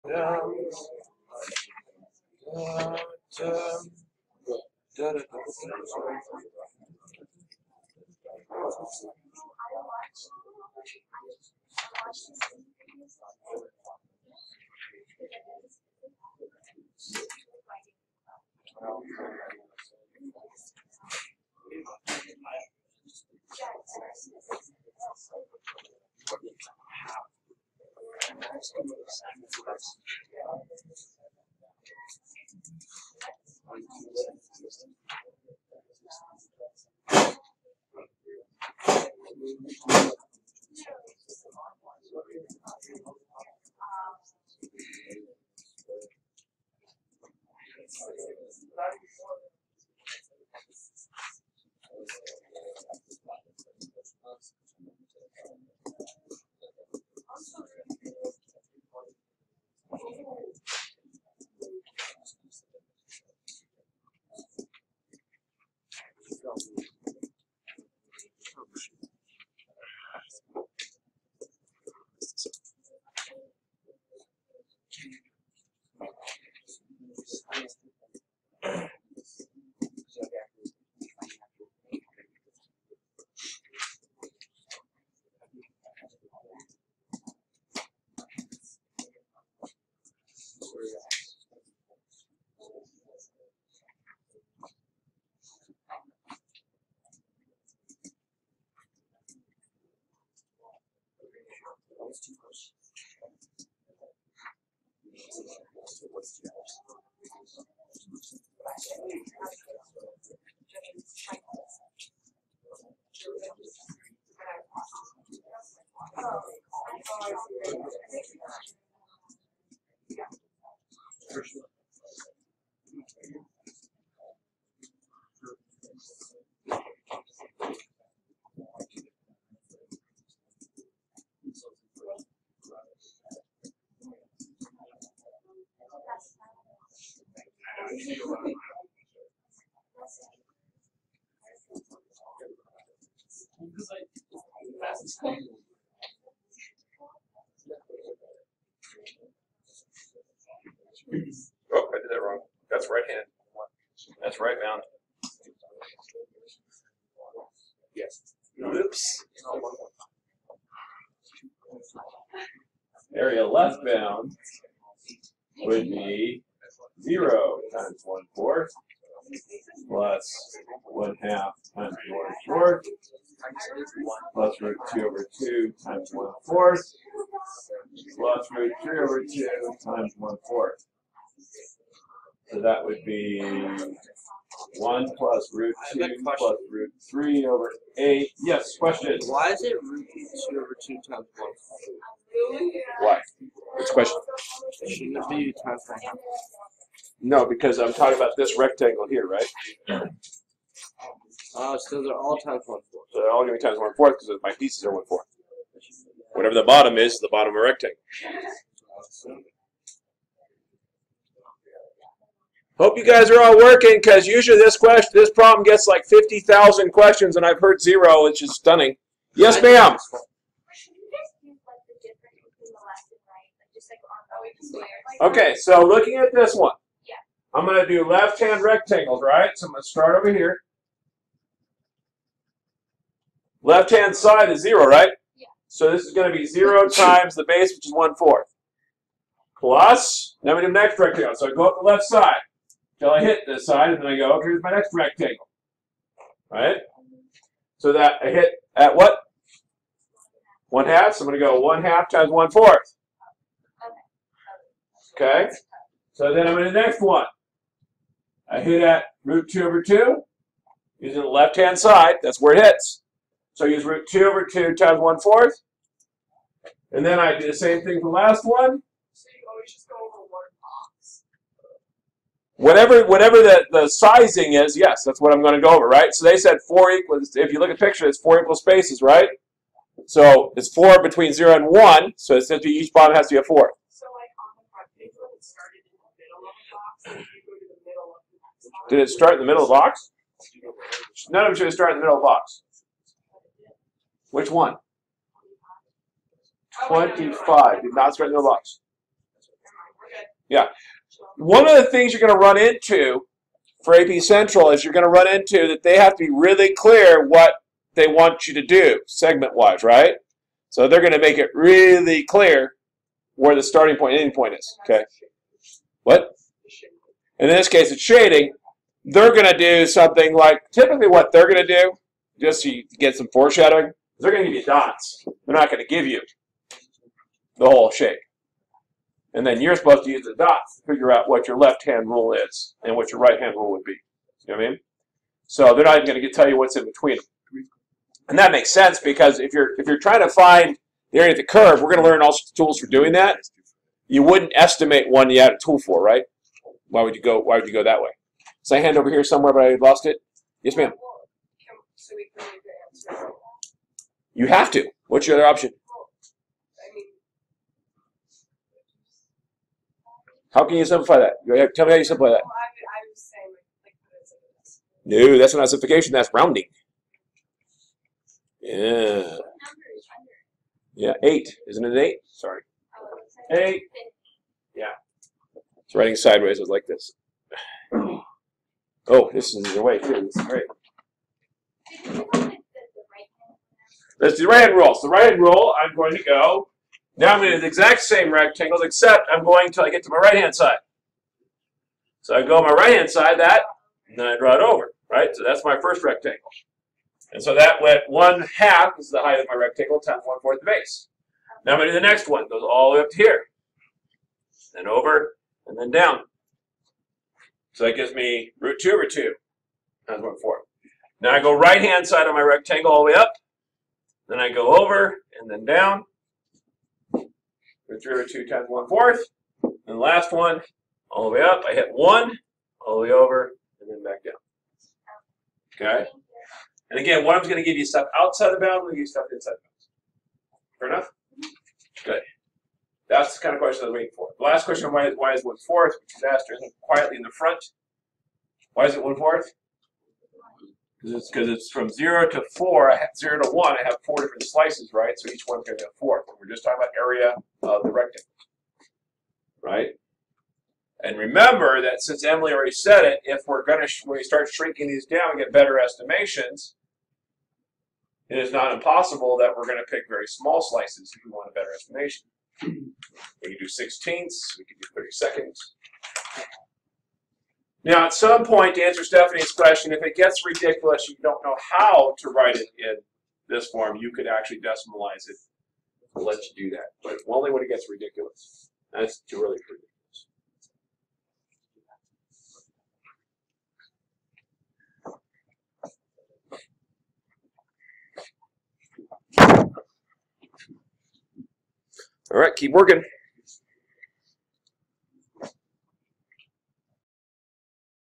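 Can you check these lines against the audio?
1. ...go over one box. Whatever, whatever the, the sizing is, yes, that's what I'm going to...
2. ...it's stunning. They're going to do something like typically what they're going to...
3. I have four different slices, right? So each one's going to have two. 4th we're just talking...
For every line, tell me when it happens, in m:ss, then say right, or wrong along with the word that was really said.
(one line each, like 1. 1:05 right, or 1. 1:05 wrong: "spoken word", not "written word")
1. 4:29 right
2. 5:17 wrong: "shading", not "stunning"
3. 7:23 wrong: "four", not "two".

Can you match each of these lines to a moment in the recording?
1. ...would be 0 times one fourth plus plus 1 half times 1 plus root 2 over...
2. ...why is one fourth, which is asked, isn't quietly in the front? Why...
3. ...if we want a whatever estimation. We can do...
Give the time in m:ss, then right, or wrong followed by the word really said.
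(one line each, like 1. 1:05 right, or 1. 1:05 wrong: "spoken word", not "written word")
1. 2:45 right
2. 7:15 right
3. 7:41 wrong: "better", not "whatever".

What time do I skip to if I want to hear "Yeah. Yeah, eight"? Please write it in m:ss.
6:08.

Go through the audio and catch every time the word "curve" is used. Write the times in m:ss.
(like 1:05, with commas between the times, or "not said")
5:41.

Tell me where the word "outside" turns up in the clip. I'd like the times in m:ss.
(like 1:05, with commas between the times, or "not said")
7:08.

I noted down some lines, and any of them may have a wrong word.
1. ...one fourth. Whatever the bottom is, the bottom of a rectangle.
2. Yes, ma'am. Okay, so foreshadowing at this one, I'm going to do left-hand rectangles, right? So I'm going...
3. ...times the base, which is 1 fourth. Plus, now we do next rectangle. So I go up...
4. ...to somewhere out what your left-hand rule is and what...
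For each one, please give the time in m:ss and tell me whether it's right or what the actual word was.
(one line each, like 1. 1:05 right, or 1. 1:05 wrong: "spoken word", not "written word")
1. 3:24 right
2. 3:39 wrong: "looking", not "foreshadowing"
3. 3:56 right
4. 5:30 wrong: "figure", not "somewhere".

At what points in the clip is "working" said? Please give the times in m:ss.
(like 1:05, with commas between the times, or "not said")
3:33, 8:12.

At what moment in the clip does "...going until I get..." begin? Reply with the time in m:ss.
6:29.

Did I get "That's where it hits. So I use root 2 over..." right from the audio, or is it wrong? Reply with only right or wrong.
right.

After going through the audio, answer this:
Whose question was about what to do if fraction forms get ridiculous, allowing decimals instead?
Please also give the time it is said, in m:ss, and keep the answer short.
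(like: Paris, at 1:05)
Stephanie, at 7:49.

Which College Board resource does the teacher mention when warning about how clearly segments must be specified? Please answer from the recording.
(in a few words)
AP Central.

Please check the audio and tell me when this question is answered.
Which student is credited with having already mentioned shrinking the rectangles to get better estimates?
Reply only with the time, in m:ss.
7:32.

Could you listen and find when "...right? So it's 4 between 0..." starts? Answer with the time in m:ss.
4:39.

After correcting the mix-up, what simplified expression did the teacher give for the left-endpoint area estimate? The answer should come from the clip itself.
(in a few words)
1 plus root 2 plus root 3 over 8.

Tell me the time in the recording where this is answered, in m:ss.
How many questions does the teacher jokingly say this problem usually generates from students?
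3:36.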